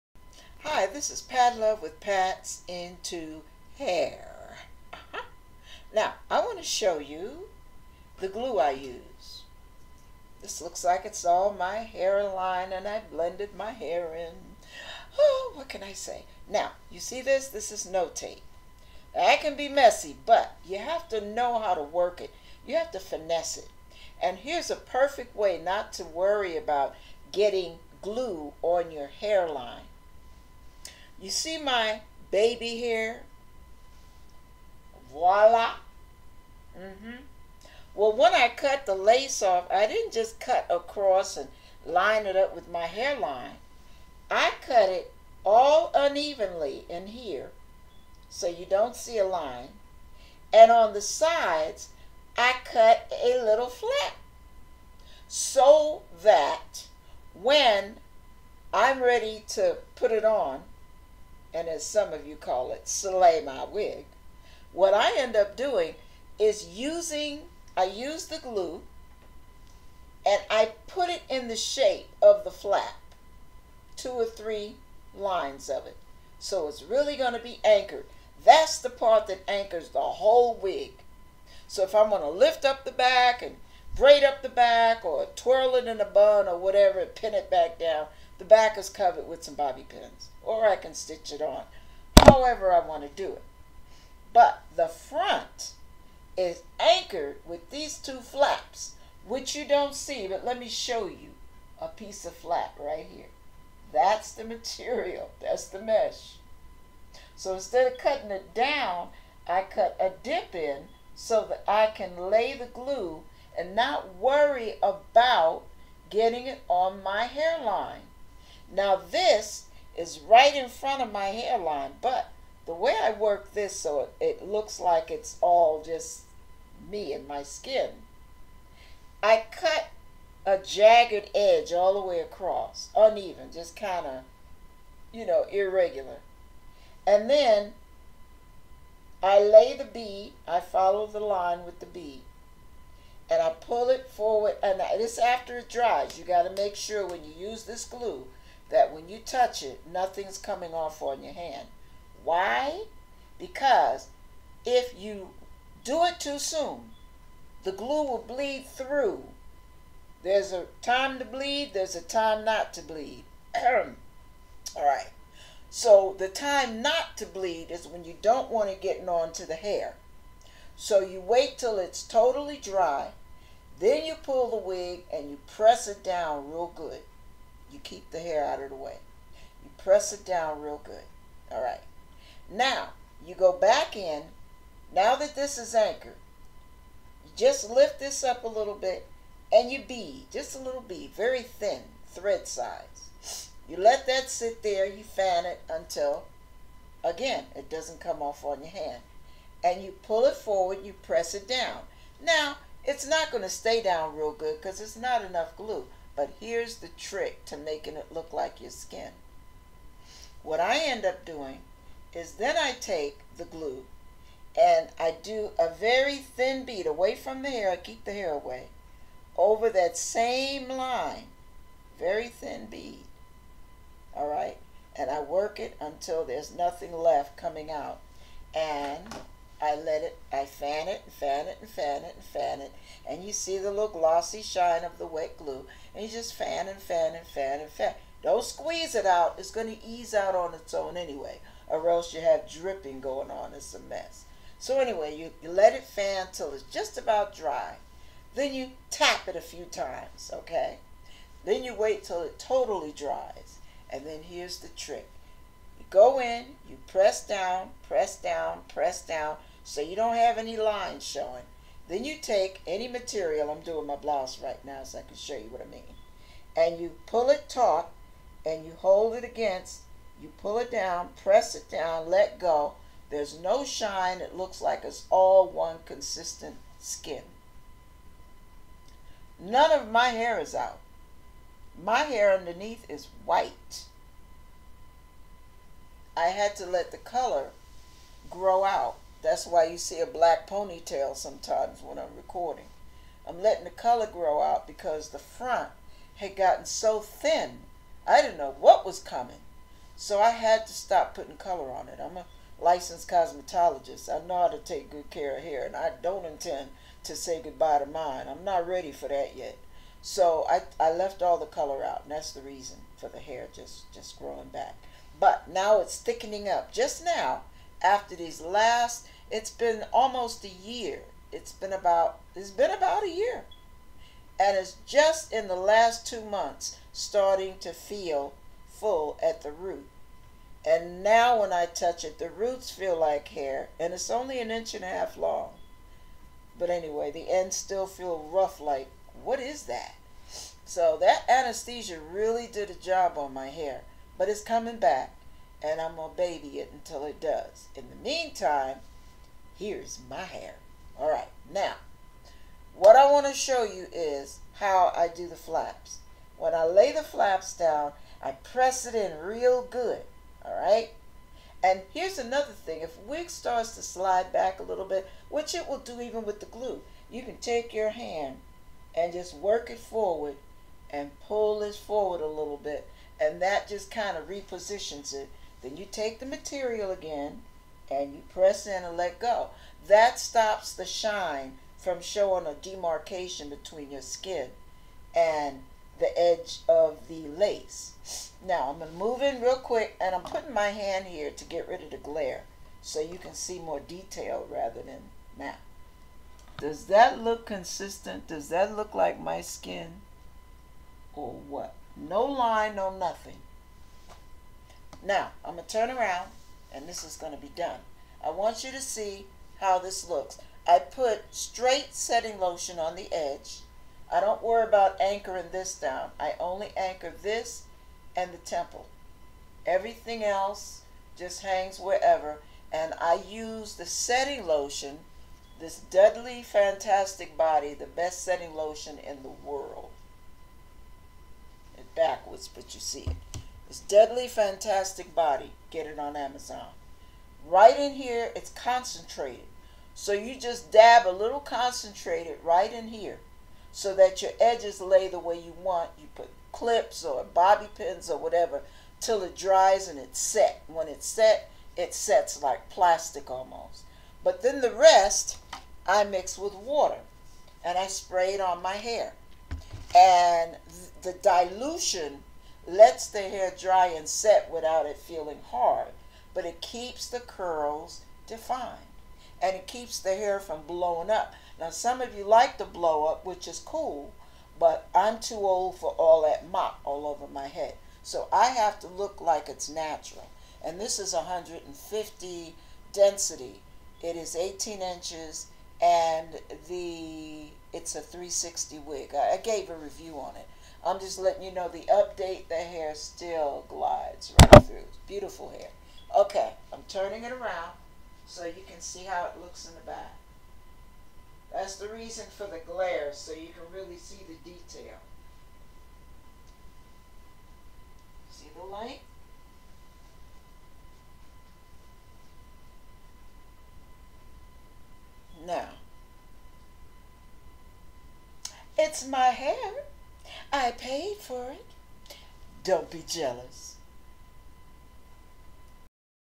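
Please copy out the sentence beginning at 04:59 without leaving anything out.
So I had to stop putting color on it.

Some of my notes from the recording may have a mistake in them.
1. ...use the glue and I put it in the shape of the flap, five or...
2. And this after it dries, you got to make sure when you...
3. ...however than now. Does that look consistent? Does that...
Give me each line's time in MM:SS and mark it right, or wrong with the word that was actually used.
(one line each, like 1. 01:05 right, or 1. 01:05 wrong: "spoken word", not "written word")
1. 01:07 wrong: "two", not "five"
2. 02:24 right
3. 06:34 wrong: "rather", not "however".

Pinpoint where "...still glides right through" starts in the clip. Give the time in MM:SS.
08:12.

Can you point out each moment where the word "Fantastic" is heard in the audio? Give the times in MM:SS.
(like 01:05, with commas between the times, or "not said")
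07:06, 07:14.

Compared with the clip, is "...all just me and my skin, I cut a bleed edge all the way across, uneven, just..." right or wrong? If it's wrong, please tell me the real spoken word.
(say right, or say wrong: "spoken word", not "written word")
wrong: "jagged", not "bleed".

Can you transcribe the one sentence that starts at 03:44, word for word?
And I work it until there's nothing left coming out.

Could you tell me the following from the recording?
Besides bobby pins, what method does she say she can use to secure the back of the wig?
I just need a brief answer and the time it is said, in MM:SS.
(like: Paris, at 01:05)
stitch it on, at 01:30.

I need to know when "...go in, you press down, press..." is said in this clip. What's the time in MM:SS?
04:15.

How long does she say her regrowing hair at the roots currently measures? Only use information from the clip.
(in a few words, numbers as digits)
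an inch and a half.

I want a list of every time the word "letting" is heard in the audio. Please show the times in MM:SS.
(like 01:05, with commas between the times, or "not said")
04:53, 08:11.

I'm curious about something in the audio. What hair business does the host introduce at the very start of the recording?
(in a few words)
Pat's Into Hair.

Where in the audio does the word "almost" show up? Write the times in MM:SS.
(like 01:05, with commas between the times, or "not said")
05:19, 07:33.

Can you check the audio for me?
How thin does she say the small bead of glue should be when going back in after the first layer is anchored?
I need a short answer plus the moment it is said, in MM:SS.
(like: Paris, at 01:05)
thread size, at 03:12.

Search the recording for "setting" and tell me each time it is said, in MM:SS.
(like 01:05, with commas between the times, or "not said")
06:51, 07:03, 07:08.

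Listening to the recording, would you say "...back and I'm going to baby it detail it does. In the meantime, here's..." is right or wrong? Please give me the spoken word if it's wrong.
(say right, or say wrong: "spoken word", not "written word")
wrong: "until", not "detail".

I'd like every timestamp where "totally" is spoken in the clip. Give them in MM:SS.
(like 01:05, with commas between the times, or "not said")
02:52, 04:12.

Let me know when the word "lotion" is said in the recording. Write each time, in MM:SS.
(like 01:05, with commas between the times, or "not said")
06:52, 07:04, 07:08.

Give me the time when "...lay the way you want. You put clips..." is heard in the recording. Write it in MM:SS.
07:24.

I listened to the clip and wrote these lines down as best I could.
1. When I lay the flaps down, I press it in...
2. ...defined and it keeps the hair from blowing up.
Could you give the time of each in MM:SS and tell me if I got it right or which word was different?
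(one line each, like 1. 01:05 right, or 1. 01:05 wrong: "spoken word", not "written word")
1. 05:56 right
2. 07:48 right.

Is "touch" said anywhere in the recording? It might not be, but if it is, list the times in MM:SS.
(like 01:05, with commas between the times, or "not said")
02:29, 05:31.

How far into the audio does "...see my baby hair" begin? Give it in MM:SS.
00:31.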